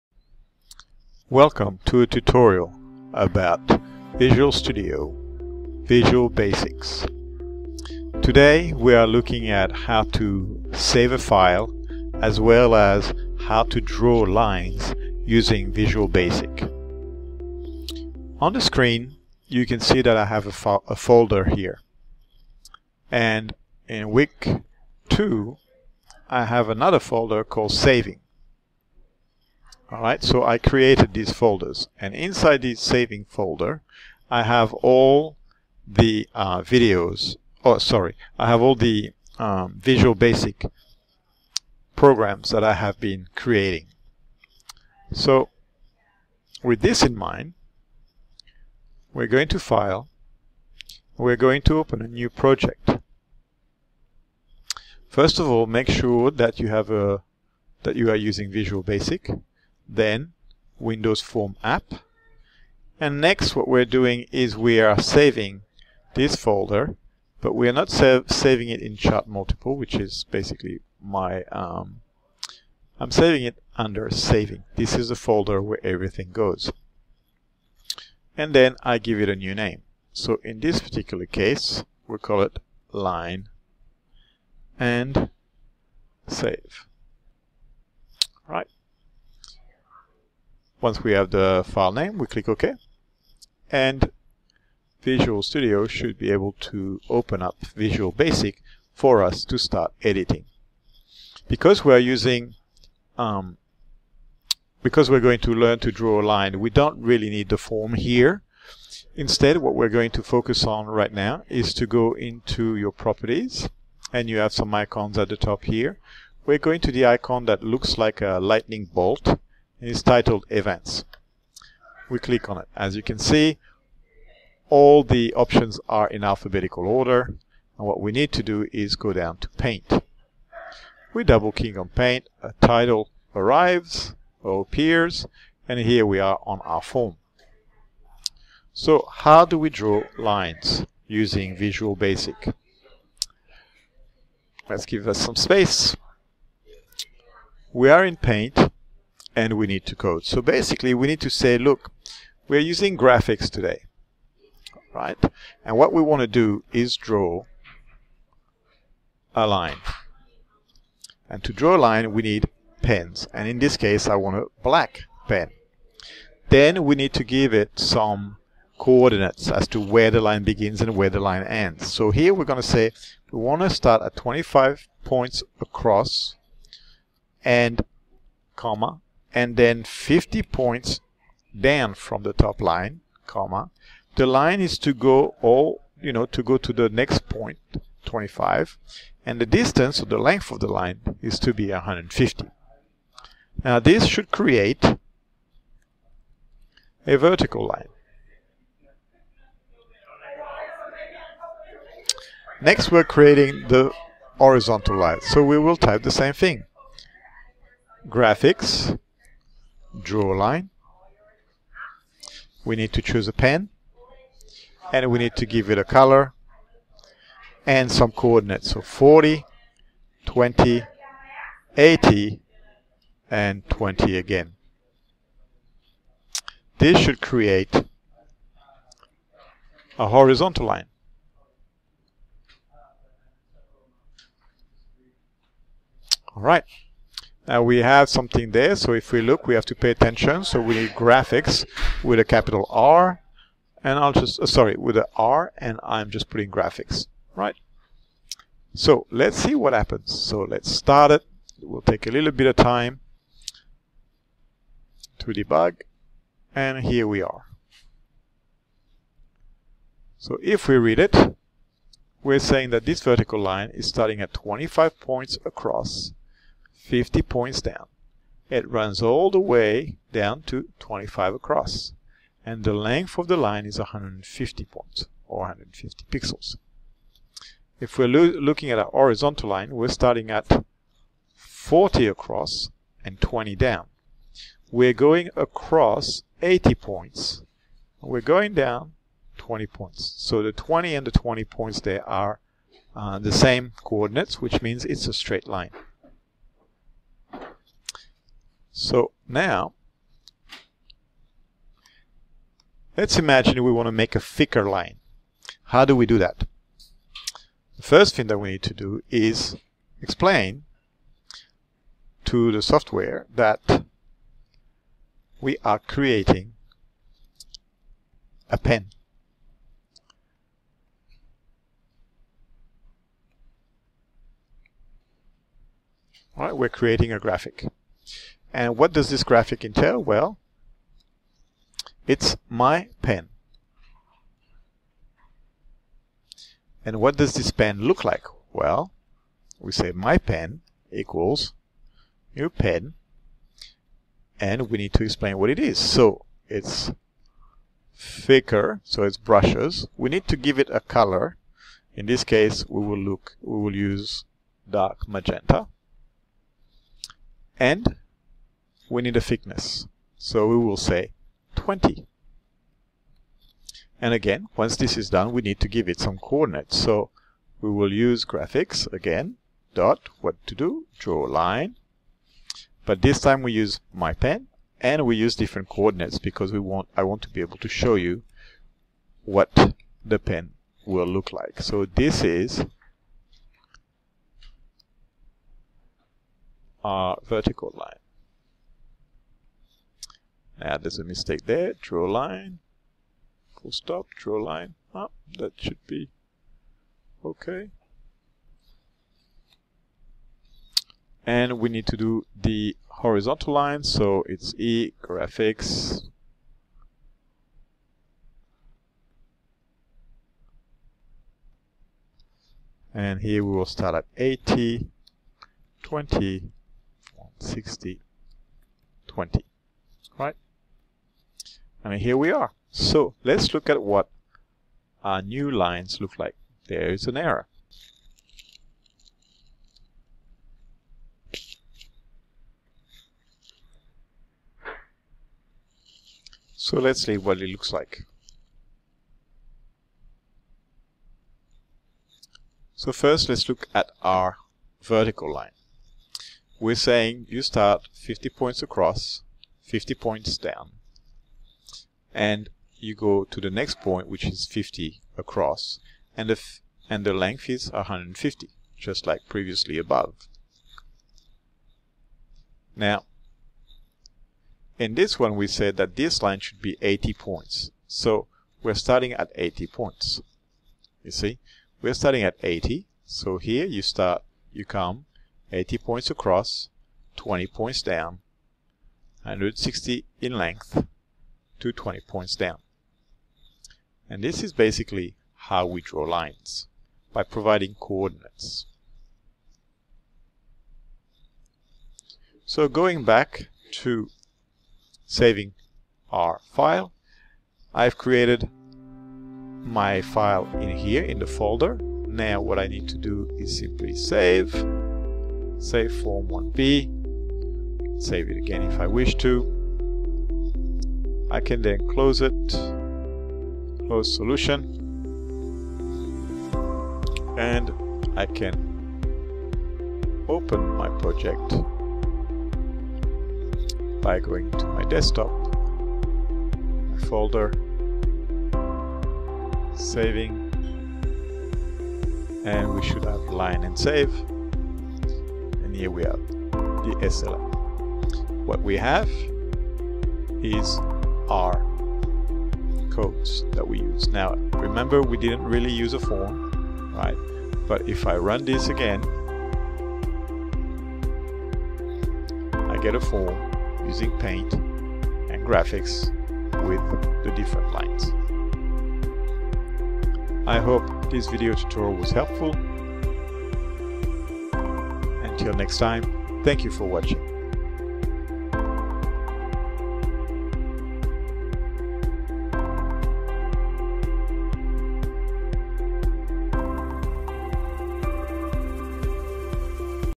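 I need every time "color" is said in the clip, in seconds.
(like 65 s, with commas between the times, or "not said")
215 s, 350 s.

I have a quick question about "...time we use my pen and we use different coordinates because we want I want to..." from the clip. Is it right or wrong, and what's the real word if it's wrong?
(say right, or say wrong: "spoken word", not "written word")
right.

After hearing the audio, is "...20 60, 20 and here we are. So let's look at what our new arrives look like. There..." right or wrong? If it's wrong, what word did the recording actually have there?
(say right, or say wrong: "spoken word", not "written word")
wrong: "lines", not "arrives".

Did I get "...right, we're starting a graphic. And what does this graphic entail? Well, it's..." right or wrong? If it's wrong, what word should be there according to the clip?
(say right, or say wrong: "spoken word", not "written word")
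wrong: "creating", not "starting".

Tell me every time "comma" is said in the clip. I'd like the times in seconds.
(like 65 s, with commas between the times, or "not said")
178 s, 183 s.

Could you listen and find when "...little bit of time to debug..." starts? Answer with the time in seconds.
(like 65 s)
252 s.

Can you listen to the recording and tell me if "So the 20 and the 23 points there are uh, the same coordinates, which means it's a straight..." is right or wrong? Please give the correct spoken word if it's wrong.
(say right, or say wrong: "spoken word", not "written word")
wrong: "20", not "23".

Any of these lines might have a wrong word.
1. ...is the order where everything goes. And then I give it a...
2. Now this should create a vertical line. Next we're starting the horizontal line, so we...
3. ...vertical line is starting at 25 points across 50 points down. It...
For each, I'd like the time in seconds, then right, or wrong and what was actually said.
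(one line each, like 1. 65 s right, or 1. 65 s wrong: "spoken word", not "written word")
1. 74 s wrong: "folder", not "order"
2. 193 s wrong: "creating", not "starting"
3. 263 s right.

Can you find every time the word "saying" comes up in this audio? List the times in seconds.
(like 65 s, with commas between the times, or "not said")
262 s, 446 s.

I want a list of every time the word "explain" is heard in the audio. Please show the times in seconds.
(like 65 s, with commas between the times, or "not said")
310 s, 345 s.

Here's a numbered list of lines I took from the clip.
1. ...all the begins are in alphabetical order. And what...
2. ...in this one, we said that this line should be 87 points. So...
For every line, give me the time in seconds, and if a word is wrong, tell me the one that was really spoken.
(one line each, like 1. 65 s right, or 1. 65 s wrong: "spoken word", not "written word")
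1. 124 s wrong: "options", not "begins"
2. 464 s wrong: "80", not "87".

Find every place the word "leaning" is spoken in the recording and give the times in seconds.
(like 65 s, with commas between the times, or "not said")
not said.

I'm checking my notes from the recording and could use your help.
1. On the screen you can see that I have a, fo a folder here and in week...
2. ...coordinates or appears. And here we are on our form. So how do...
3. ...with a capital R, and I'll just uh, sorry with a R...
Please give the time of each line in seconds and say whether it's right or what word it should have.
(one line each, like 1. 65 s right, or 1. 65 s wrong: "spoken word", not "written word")
1. 18 s right
2. 133 s wrong: "arrives", not "coordinates"
3. 242 s right.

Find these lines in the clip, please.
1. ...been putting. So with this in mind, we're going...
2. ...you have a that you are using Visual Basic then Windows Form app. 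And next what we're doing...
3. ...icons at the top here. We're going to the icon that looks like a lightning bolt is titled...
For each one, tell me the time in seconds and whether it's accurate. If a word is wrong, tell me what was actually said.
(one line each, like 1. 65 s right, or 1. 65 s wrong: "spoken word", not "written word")
1. 43 s wrong: "creating", not "putting"
2. 56 s right
3. 114 s right.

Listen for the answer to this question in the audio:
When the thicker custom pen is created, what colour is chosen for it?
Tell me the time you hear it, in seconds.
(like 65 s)
354 s.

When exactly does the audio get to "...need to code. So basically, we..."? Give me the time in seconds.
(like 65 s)
149 s.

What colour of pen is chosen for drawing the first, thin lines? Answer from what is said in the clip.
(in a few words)
black.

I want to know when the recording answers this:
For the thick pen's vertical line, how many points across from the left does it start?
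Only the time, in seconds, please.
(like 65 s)
447 s.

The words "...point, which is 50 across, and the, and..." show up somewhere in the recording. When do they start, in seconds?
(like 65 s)
453 s.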